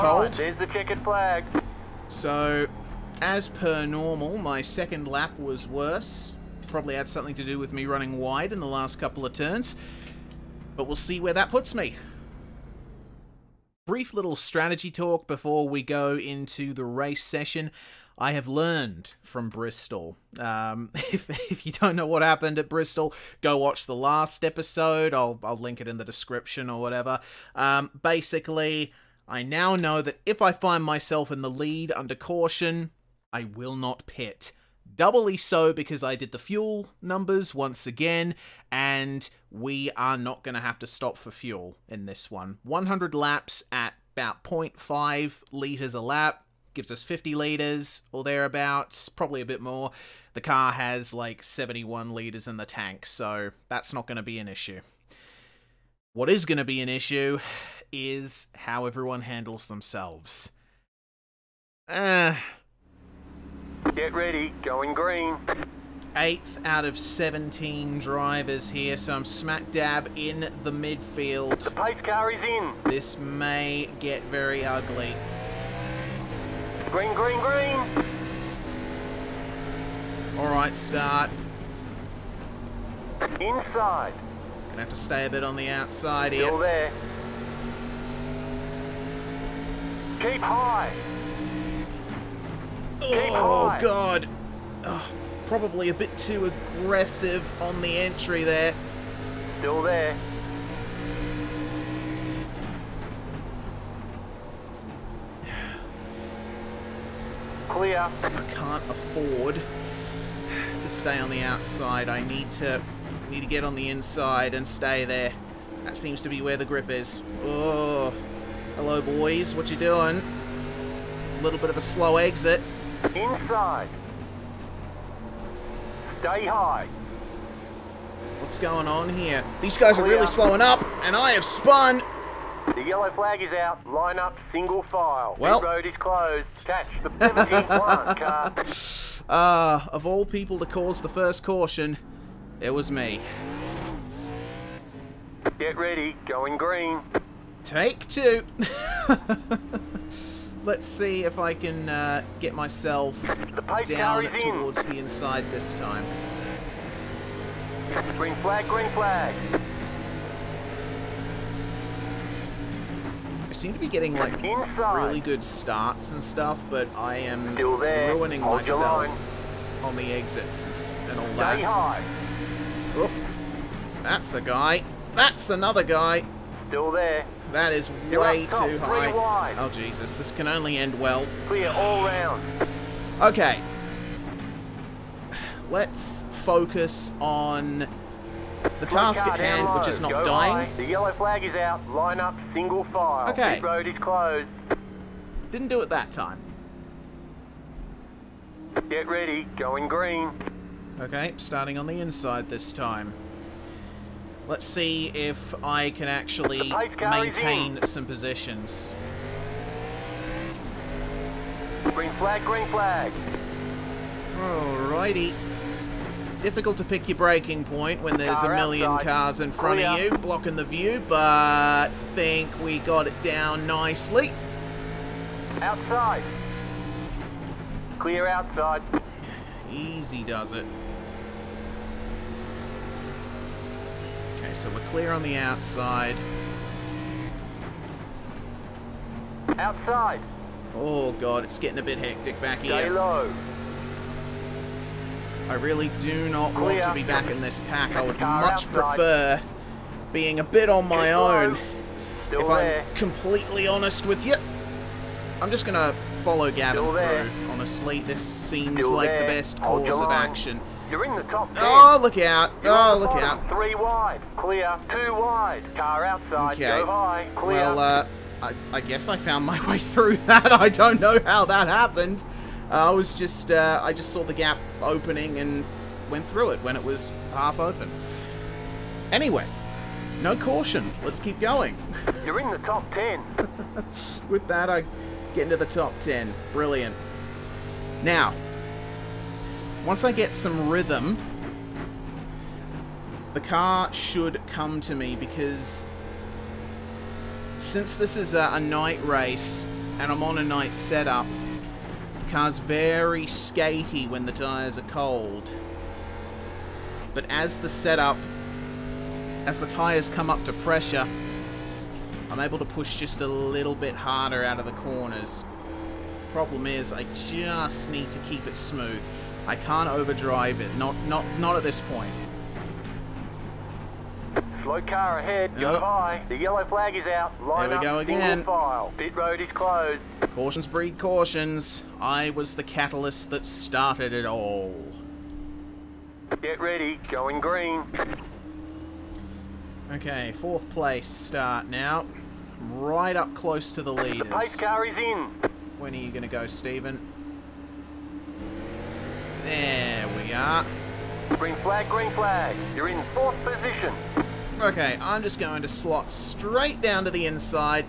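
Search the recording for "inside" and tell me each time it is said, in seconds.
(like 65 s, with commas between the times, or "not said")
83 s, 113 s, 123 s, 154 s, 202 s, 357 s.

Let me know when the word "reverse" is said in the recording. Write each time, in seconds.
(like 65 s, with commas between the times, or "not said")
not said.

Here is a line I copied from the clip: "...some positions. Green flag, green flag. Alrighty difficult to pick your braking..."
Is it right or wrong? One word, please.
right.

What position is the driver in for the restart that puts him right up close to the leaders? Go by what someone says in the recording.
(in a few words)
4th.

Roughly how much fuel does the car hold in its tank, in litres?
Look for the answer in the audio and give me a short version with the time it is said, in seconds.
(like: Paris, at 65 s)
71 litres, at 51 s.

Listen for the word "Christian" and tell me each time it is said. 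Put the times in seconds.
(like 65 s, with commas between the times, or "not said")
not said.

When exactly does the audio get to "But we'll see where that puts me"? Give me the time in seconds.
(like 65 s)
10 s.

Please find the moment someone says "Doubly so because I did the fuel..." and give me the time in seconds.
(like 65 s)
34 s.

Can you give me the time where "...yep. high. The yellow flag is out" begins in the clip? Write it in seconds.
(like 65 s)
325 s.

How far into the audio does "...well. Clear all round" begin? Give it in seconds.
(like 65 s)
180 s.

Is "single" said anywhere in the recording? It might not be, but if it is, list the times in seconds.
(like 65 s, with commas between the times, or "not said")
134 s, 192 s.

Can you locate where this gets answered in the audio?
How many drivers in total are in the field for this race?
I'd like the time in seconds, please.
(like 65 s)
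66 s.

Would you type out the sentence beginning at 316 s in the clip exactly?
Problem is, I just need to keep it smooth.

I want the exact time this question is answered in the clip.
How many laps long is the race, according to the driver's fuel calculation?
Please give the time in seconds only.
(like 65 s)
42 s.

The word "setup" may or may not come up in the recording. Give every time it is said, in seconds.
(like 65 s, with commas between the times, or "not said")
300 s, 307 s.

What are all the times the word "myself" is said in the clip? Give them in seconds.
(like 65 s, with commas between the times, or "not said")
30 s, 152 s, 168 s.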